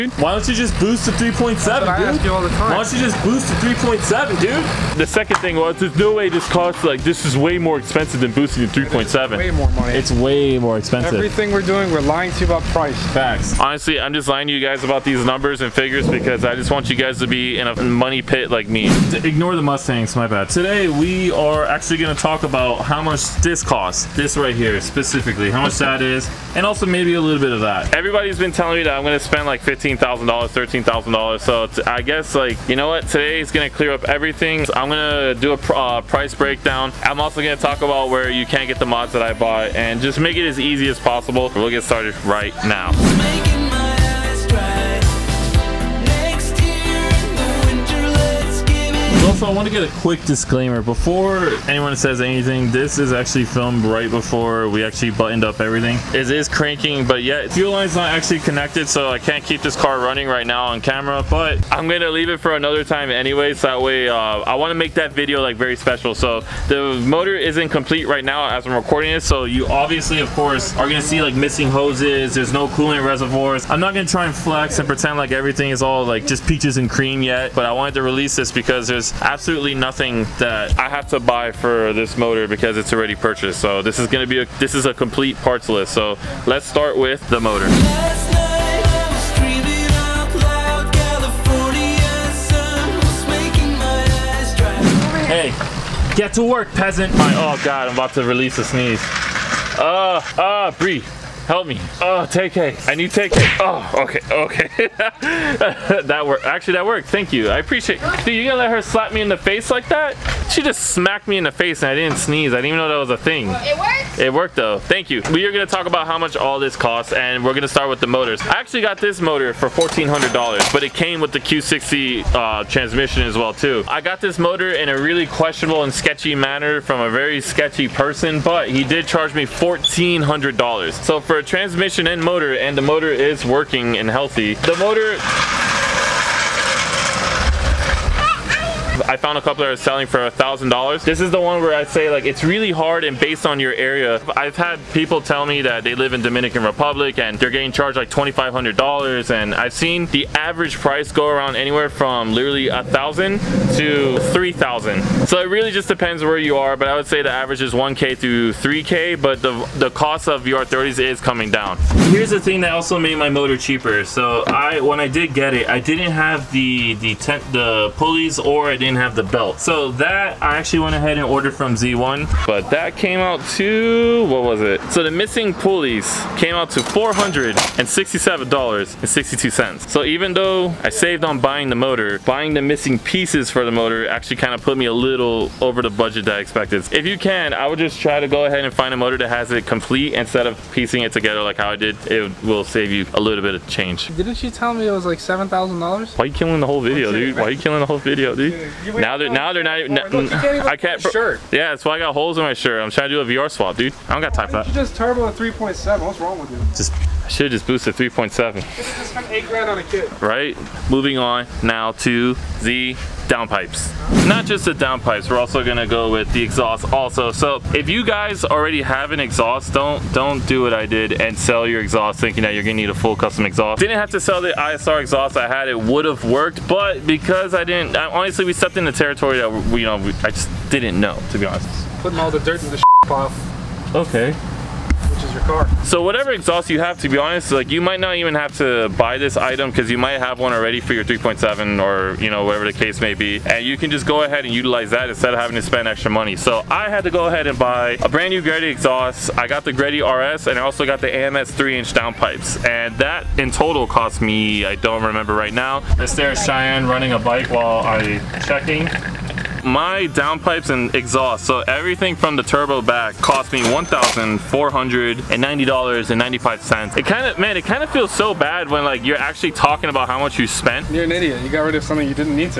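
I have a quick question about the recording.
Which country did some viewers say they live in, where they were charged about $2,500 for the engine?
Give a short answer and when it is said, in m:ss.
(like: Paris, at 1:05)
Dominican Republic, at 2:26.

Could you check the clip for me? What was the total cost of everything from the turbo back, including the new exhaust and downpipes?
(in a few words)
$1,490.95.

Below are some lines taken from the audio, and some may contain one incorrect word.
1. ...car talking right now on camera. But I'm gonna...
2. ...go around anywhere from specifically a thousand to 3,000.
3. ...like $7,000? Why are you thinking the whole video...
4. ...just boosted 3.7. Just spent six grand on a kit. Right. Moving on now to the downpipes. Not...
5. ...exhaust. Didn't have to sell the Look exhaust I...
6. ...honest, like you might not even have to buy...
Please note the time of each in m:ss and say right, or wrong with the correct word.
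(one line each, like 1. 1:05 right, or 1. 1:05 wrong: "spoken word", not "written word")
1. 0:59 wrong: "running", not "talking"
2. 2:31 wrong: "literally", not "specifically"
3. 3:15 wrong: "killing", not "thinking"
4. 3:27 wrong: "eight", not "six"
5. 3:43 wrong: "ISR", not "Look"
6. 3:57 right.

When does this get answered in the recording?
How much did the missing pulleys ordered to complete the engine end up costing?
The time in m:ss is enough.
2:56.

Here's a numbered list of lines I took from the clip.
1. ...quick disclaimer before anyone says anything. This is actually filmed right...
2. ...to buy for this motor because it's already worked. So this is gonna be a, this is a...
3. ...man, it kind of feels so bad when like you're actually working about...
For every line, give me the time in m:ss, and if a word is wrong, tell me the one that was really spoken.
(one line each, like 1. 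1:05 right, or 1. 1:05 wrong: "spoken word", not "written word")
1. 0:50 right
2. 1:21 wrong: "purchased", not "worked"
3. 4:27 wrong: "talking", not "working".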